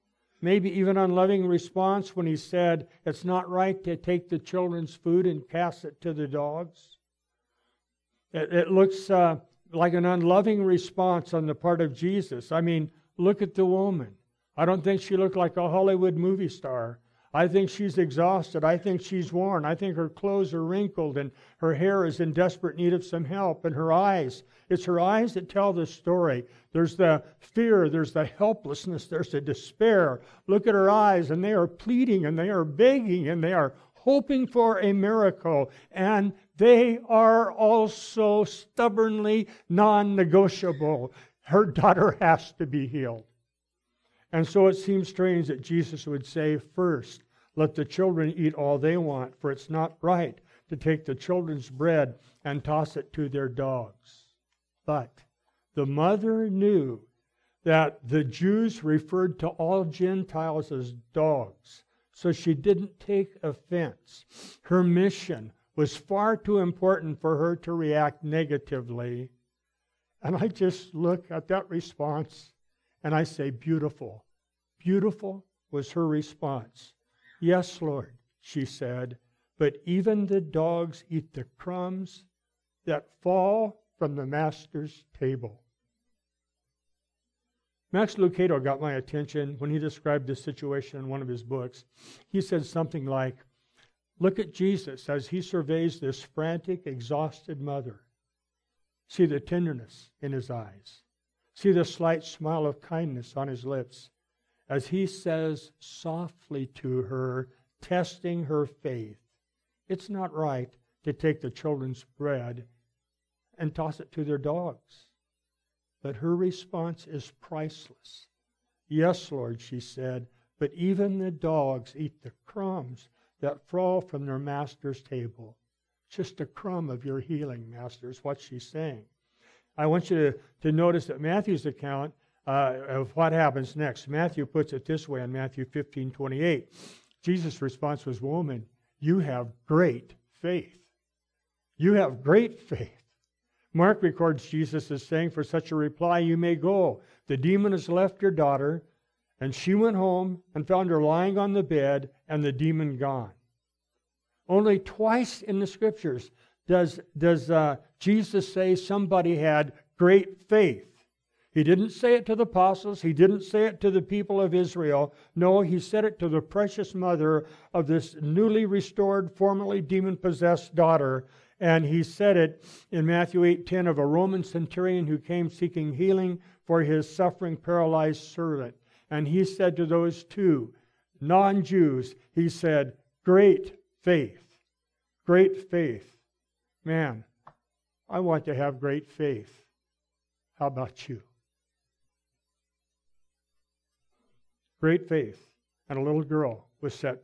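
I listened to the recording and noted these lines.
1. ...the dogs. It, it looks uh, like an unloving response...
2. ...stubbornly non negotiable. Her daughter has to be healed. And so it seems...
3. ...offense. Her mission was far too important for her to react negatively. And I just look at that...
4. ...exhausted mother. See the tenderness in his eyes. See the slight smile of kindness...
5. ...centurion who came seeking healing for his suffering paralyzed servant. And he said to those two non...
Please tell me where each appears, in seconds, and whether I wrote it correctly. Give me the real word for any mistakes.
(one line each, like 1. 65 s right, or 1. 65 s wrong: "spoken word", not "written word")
1. 6 s right
2. 38 s right
3. 63 s right
4. 96 s right
5. 174 s right.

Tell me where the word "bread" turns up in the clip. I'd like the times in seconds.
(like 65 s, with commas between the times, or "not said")
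51 s, 112 s.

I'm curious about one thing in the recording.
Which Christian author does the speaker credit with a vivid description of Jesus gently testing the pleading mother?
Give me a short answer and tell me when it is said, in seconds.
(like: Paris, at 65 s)
Max Lucado, at 87 s.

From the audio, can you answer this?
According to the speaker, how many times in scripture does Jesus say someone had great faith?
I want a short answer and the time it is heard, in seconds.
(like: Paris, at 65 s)
2, at 154 s.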